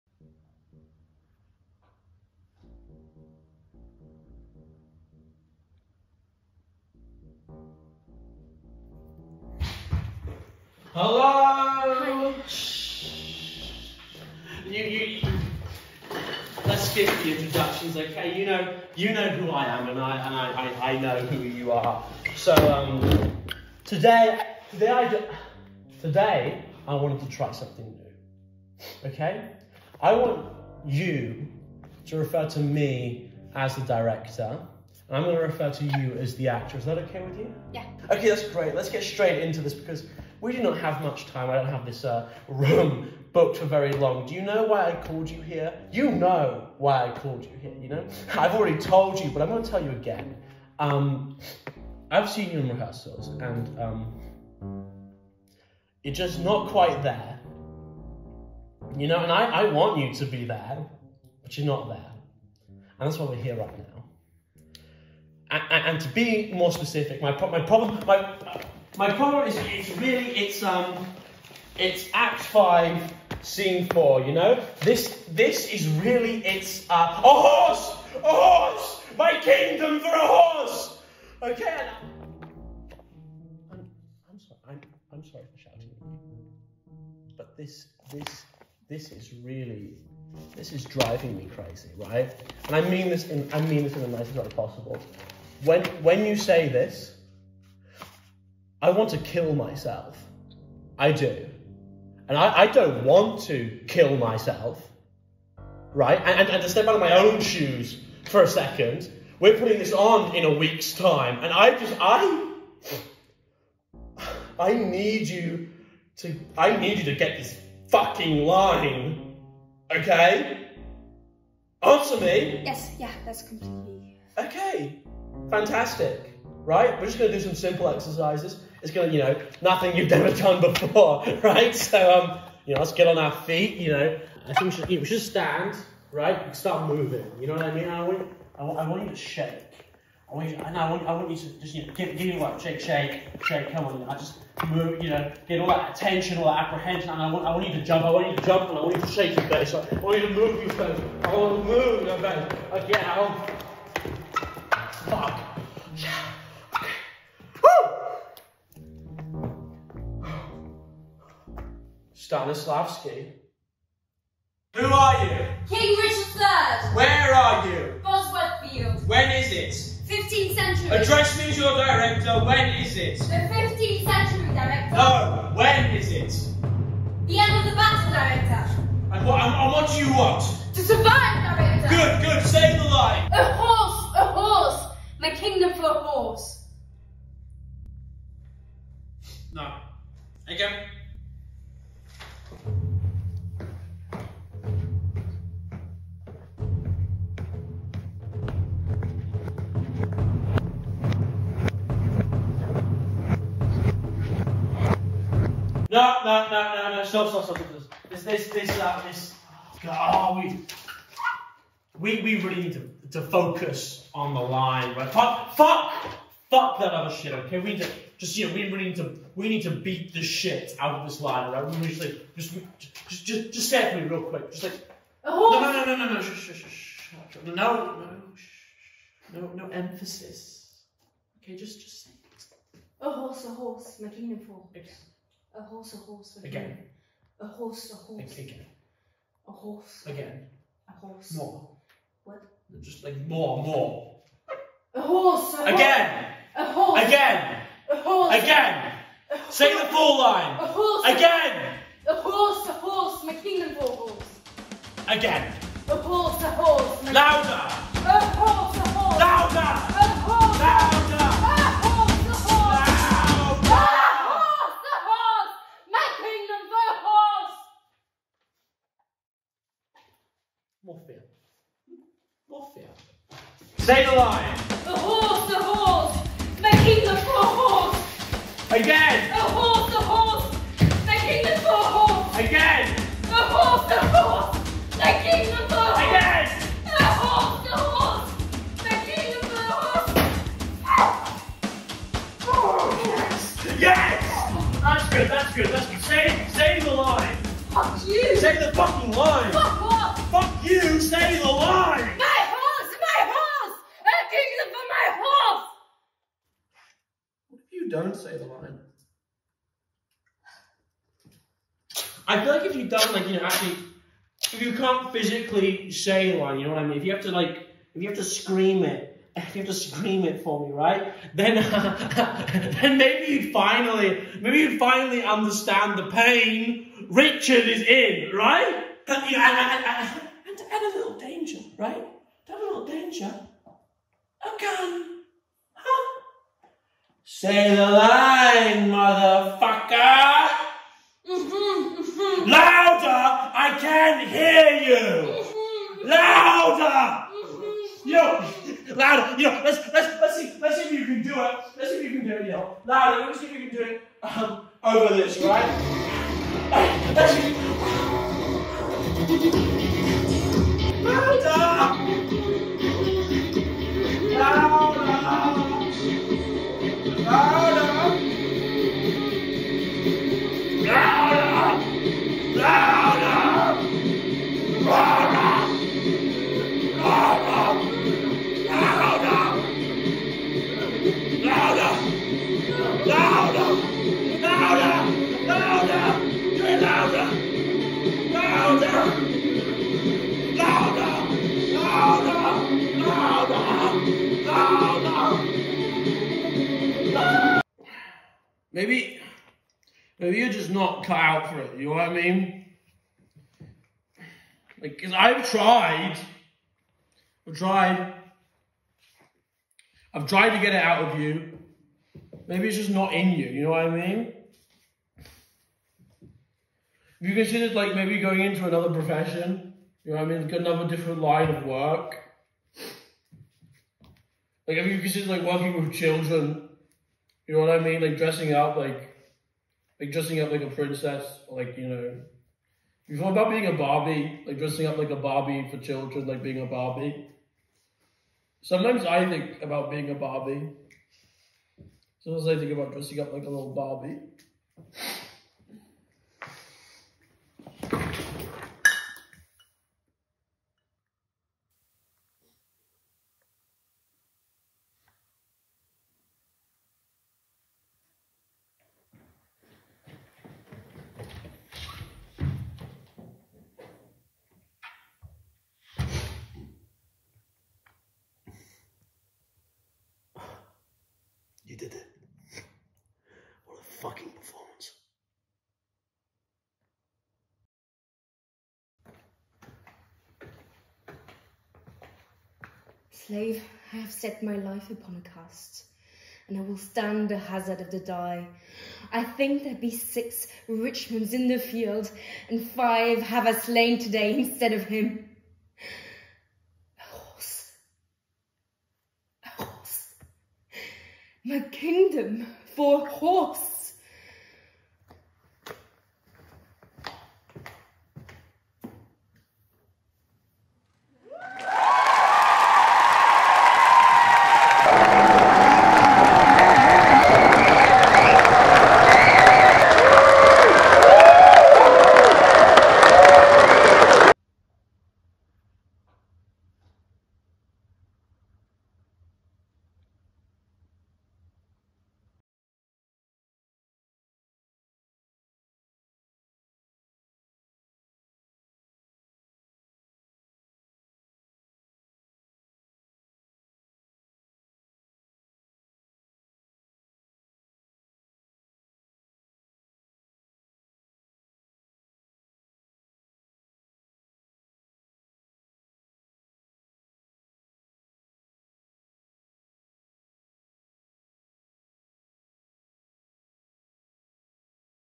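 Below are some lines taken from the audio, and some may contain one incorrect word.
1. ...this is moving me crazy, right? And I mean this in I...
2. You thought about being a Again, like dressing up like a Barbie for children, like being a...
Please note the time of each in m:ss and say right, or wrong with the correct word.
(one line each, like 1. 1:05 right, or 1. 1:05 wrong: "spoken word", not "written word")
1. 1:30 wrong: "driving", not "moving"
2. 7:13 wrong: "Barbie", not "Again".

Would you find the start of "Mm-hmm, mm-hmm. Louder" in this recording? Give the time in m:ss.
5:41.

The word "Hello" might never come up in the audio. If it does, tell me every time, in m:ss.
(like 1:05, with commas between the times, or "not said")
0:10.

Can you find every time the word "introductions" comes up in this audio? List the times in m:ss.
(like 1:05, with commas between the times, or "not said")
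0:17.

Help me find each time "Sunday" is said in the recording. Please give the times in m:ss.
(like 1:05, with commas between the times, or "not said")
not said.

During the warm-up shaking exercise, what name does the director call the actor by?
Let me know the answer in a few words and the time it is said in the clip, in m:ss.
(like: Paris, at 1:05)
Owen, at 2:17.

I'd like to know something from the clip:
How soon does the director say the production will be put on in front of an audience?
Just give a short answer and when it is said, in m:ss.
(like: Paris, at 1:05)
In a week, at 1:50.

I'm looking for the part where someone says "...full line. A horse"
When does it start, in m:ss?
4:09.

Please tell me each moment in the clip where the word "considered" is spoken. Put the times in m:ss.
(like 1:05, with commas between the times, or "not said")
6:57, 7:04.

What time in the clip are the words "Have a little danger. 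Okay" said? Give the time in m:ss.
5:32.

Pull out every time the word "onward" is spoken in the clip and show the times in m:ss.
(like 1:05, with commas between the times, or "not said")
not said.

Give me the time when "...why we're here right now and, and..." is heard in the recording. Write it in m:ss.
1:03.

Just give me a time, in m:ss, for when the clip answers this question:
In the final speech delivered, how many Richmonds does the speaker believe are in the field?
8:09.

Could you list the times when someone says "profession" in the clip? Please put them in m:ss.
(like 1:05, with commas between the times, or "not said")
6:58.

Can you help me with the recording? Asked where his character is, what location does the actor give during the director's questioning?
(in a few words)
Bosworth Field.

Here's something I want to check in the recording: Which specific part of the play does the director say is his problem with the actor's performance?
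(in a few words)
Act Five, Scene Four.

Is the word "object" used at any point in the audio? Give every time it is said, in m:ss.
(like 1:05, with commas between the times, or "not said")
not said.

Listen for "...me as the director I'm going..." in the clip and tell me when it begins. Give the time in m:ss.
0:32.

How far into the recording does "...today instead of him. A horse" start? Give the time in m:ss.
8:13.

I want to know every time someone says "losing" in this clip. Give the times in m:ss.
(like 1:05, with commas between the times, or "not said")
not said.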